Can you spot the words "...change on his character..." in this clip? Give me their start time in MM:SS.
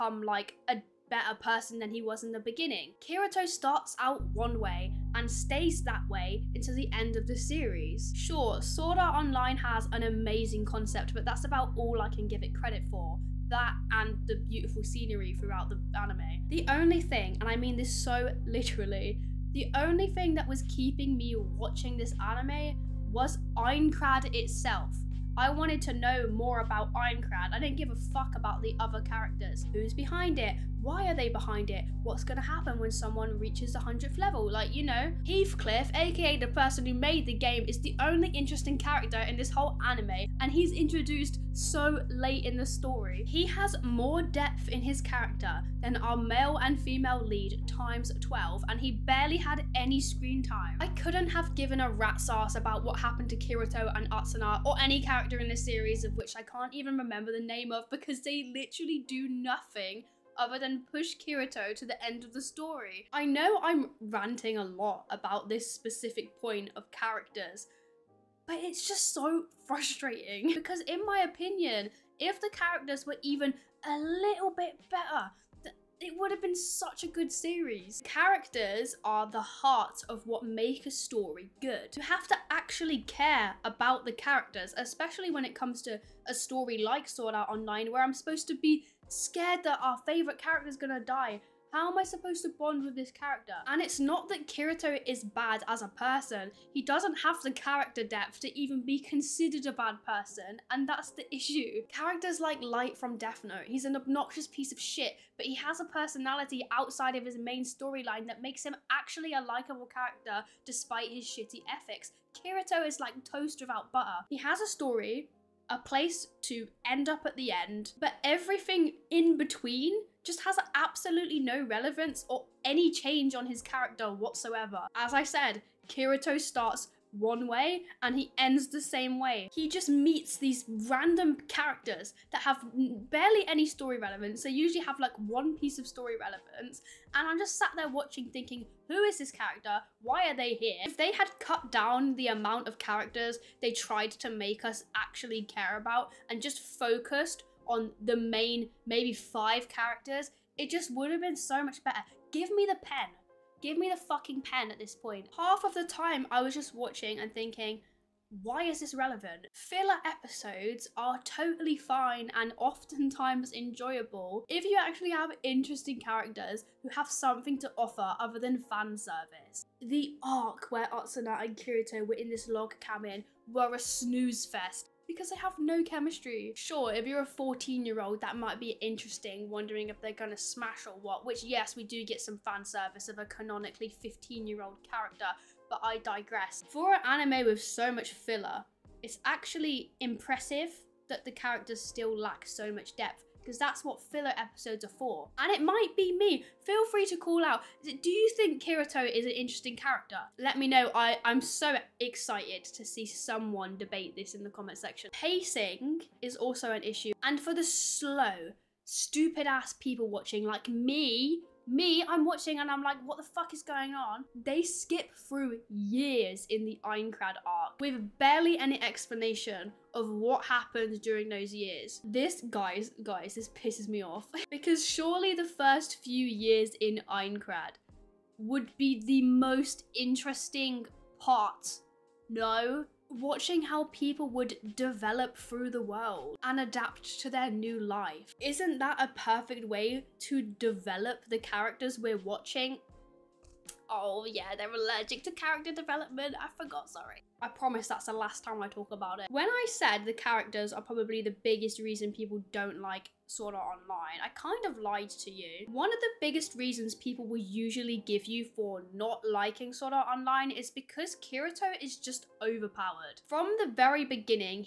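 02:02.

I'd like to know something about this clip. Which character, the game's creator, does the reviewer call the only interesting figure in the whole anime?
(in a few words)
Heathcliff.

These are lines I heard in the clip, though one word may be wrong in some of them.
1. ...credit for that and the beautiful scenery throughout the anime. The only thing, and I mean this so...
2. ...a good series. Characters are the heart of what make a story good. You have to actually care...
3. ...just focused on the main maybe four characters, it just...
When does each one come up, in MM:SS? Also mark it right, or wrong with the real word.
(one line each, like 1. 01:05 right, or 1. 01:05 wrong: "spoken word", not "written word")
1. 00:12 right
2. 01:17 right
3. 02:26 wrong: "five", not "four".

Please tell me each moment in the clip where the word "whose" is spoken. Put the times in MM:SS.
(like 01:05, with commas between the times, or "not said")
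not said.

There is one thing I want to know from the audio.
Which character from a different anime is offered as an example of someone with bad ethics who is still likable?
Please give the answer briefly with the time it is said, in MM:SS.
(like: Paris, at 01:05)
Light, at 01:42.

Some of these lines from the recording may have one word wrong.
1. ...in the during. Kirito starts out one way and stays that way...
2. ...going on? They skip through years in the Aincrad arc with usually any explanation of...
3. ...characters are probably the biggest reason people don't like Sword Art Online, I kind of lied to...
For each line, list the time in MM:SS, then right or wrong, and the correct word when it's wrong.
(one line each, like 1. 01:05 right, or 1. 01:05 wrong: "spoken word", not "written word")
1. 00:02 wrong: "beginning", not "during"
2. 03:33 wrong: "barely", not "usually"
3. 04:10 right.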